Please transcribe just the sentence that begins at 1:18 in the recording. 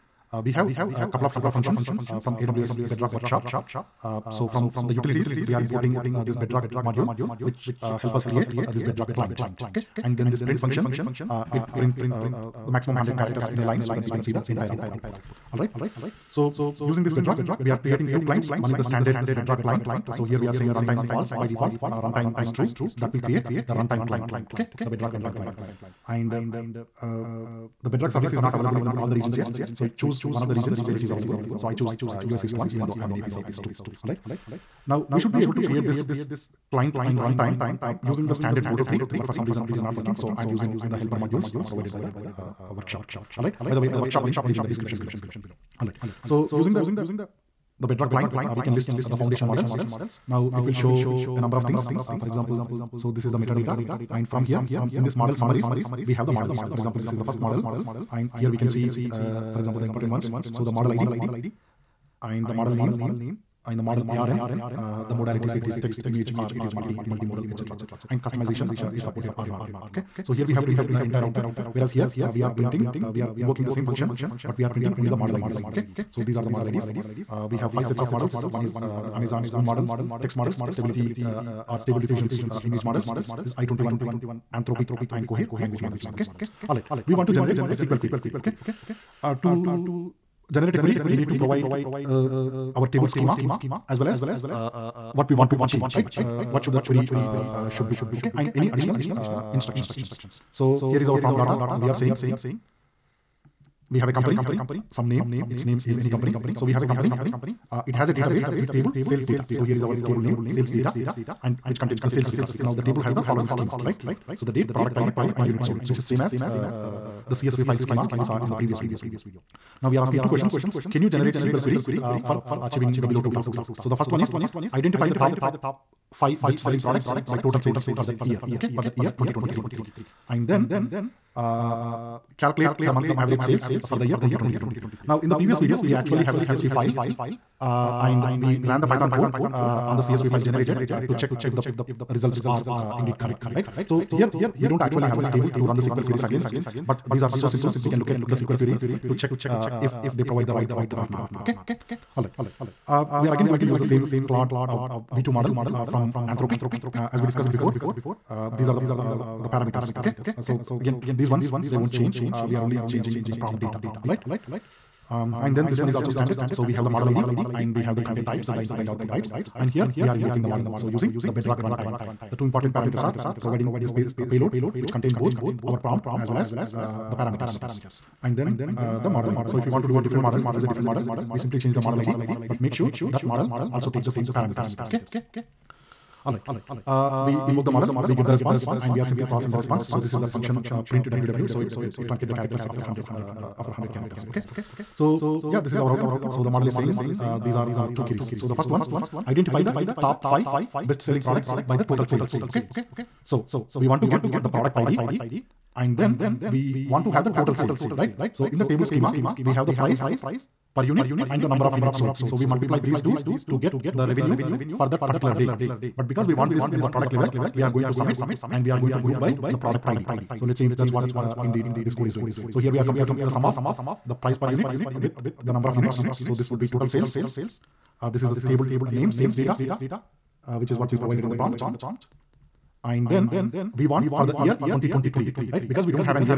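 One is uh, Amazon's own model, text models, stability uh, or stable diffusion's uh, image models.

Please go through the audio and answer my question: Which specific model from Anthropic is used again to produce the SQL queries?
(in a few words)
Claude V2.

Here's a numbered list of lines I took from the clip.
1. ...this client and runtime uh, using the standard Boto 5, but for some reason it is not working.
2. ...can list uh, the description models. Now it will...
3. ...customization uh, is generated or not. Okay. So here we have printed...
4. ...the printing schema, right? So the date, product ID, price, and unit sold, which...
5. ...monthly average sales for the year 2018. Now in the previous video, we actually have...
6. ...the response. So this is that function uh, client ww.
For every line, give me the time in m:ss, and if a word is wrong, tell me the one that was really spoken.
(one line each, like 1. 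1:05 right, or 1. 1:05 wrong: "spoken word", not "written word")
1. 0:35 wrong: "3", not "5"
2. 0:48 wrong: "foundation", not "description"
3. 1:08 wrong: "supported", not "generated"
4. 1:53 wrong: "following", not "printing"
5. 2:12 wrong: "2023", not "2018"
6. 3:09 wrong: "print", not "client".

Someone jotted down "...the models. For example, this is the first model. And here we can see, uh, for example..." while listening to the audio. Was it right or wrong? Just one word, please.
right.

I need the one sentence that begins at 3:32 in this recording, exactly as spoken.
So we multiply these two to get the revenue for that particular day.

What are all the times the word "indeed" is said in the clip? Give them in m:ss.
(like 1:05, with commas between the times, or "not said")
2:22, 3:41.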